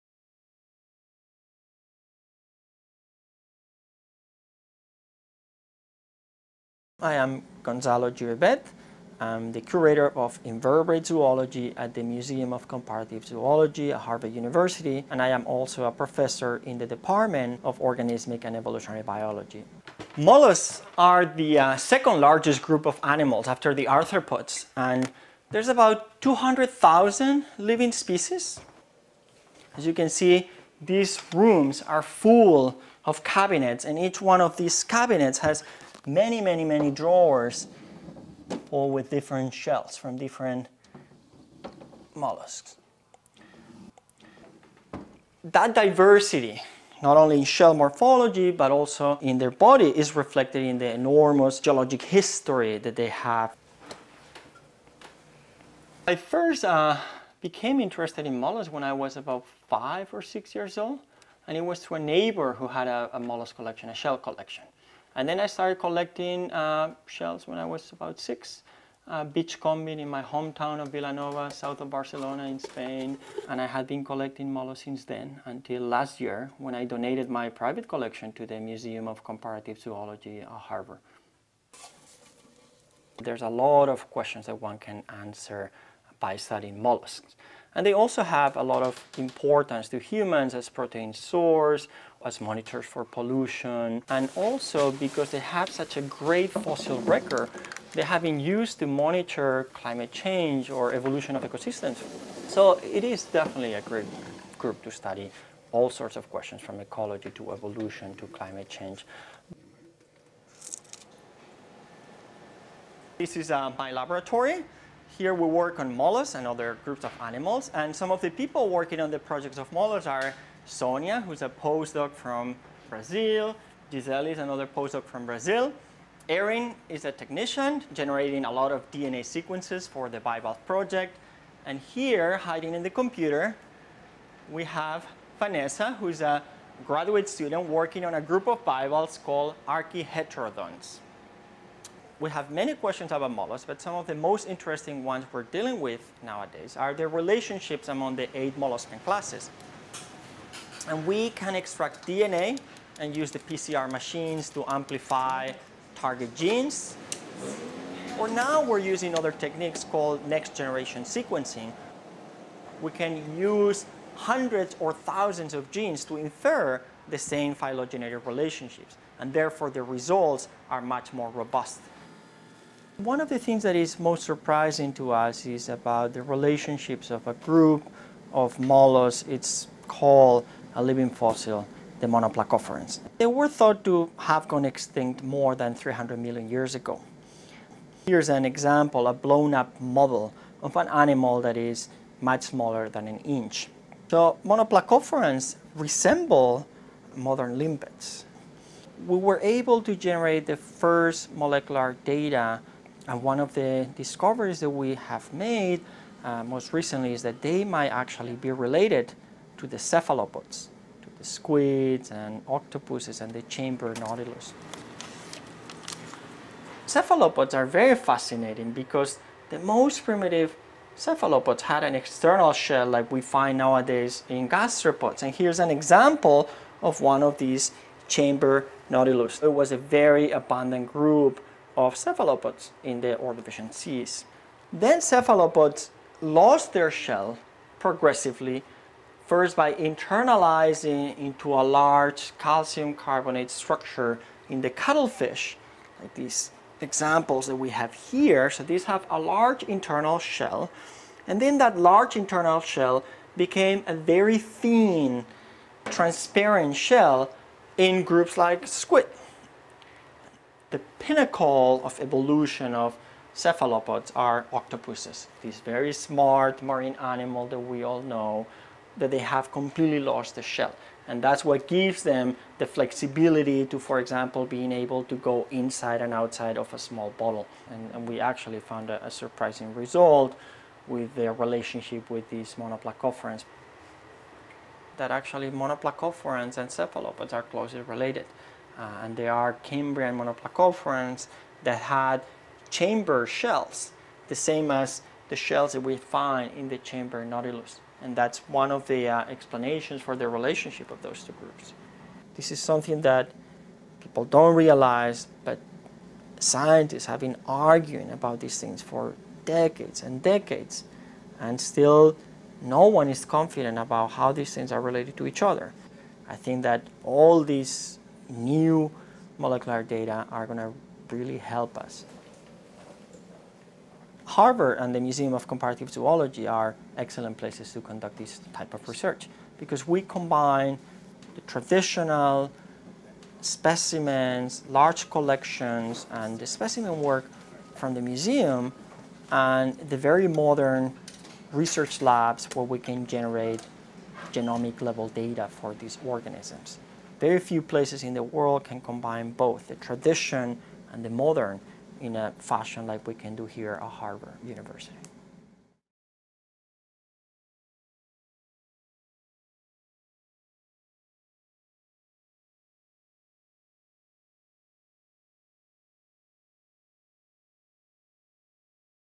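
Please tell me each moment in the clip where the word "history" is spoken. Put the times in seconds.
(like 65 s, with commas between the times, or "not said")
52 s.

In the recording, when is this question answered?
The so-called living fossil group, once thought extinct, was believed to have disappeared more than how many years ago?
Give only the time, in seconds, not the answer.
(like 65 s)
185 s.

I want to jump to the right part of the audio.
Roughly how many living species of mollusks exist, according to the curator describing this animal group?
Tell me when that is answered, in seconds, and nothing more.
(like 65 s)
26 s.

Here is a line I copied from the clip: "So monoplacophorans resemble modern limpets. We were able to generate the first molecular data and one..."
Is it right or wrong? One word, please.
right.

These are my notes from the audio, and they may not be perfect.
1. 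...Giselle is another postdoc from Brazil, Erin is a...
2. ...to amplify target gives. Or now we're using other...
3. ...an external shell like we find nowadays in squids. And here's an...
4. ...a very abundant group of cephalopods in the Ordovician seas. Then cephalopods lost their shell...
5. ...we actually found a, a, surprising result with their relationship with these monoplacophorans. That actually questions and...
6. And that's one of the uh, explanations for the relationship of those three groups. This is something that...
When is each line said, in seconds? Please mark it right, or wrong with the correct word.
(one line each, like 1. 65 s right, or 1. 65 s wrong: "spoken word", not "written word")
1. 123 s right
2. 154 s wrong: "genes", not "gives"
3. 221 s wrong: "gastropods", not "squids"
4. 229 s right
5. 278 s wrong: "monoplacophorans", not "questions"
6. 298 s wrong: "two", not "three".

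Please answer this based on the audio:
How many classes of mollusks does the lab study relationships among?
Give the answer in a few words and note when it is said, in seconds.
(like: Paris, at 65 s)
8, at 148 s.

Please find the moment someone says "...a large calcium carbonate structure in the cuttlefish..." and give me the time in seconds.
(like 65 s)
241 s.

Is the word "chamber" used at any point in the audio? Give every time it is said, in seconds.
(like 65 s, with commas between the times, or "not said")
213 s, 228 s, 292 s, 296 s.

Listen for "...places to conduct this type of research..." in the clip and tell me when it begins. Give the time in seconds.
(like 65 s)
327 s.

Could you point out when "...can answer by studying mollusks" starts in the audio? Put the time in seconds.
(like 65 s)
84 s.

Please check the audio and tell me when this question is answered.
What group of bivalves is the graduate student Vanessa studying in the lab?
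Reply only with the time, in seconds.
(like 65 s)
139 s.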